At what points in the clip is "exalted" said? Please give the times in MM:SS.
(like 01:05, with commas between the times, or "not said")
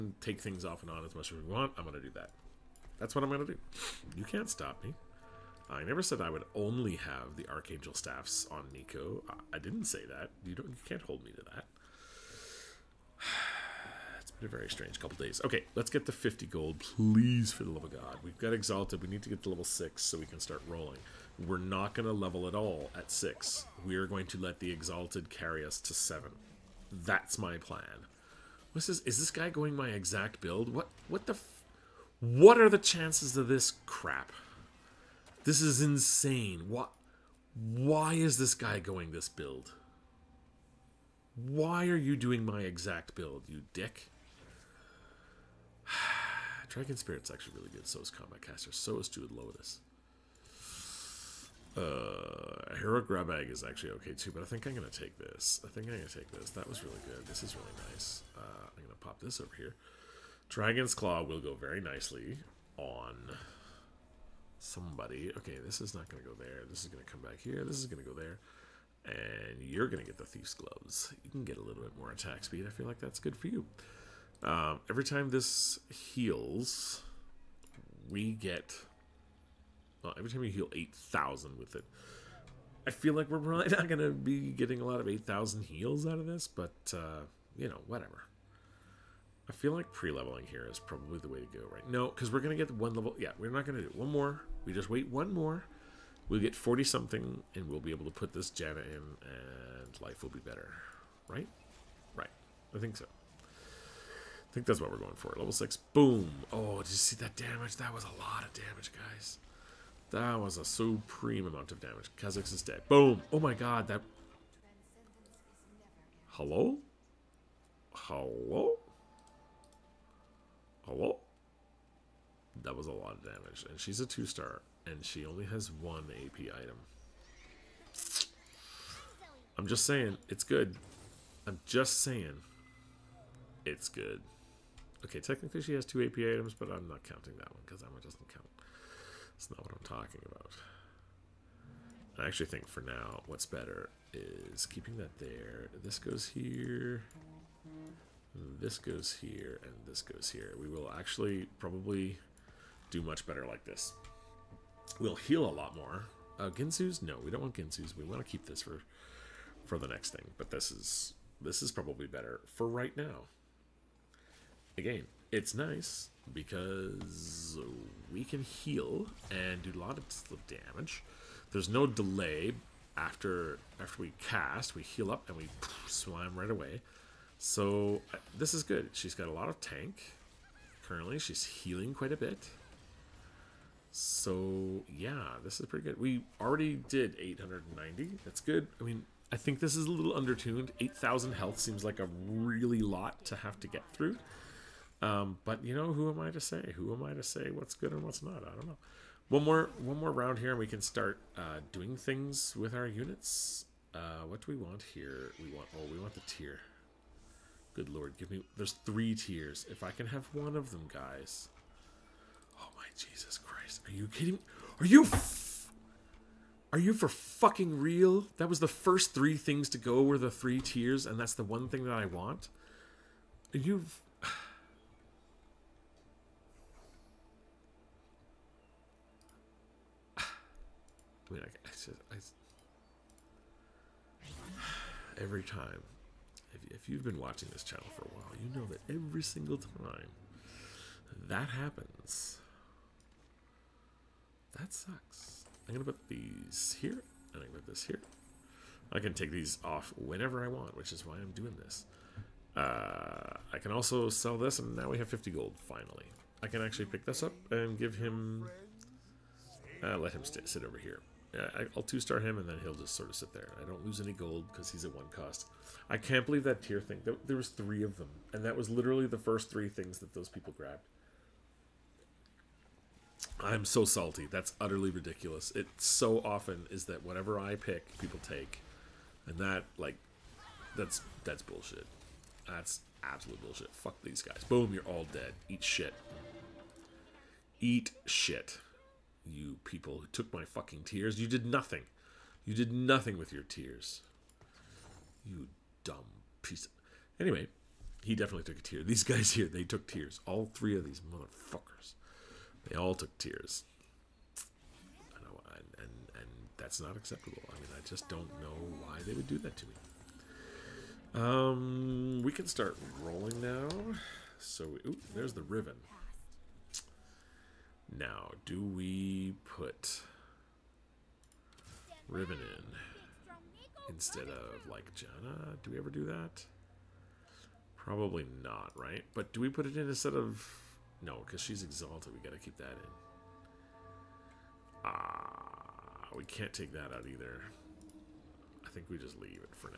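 00:18, 00:24, 05:31.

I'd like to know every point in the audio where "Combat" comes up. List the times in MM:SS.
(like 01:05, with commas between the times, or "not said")
00:48.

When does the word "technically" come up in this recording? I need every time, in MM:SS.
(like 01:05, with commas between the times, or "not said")
02:15.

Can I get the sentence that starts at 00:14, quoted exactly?
Been a very strange couple days.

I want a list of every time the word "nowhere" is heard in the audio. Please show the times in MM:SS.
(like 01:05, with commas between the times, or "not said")
not said.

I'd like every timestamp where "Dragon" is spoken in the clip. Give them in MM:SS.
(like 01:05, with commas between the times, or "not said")
00:46, 01:00.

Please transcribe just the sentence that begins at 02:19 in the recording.
That's not what I'm talking about.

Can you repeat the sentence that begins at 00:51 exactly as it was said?
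Uh, Hero Grab Egg is actually okay too, but I think I'm going to take this.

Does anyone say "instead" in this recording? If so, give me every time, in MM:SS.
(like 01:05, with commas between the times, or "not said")
05:23, 05:29.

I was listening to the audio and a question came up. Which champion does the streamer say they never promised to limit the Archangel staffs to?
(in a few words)
Neeko.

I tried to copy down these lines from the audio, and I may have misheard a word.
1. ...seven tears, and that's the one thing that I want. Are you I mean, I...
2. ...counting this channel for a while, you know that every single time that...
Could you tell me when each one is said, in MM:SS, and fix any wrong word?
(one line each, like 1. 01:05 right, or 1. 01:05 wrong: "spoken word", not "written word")
1. 03:40 wrong: "three", not "seven"
2. 03:57 wrong: "watching", not "counting".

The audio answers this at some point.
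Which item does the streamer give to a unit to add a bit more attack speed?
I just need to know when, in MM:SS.
01:10.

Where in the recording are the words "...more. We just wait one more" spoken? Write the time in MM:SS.
01:34.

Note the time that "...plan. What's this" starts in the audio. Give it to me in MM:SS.
00:27.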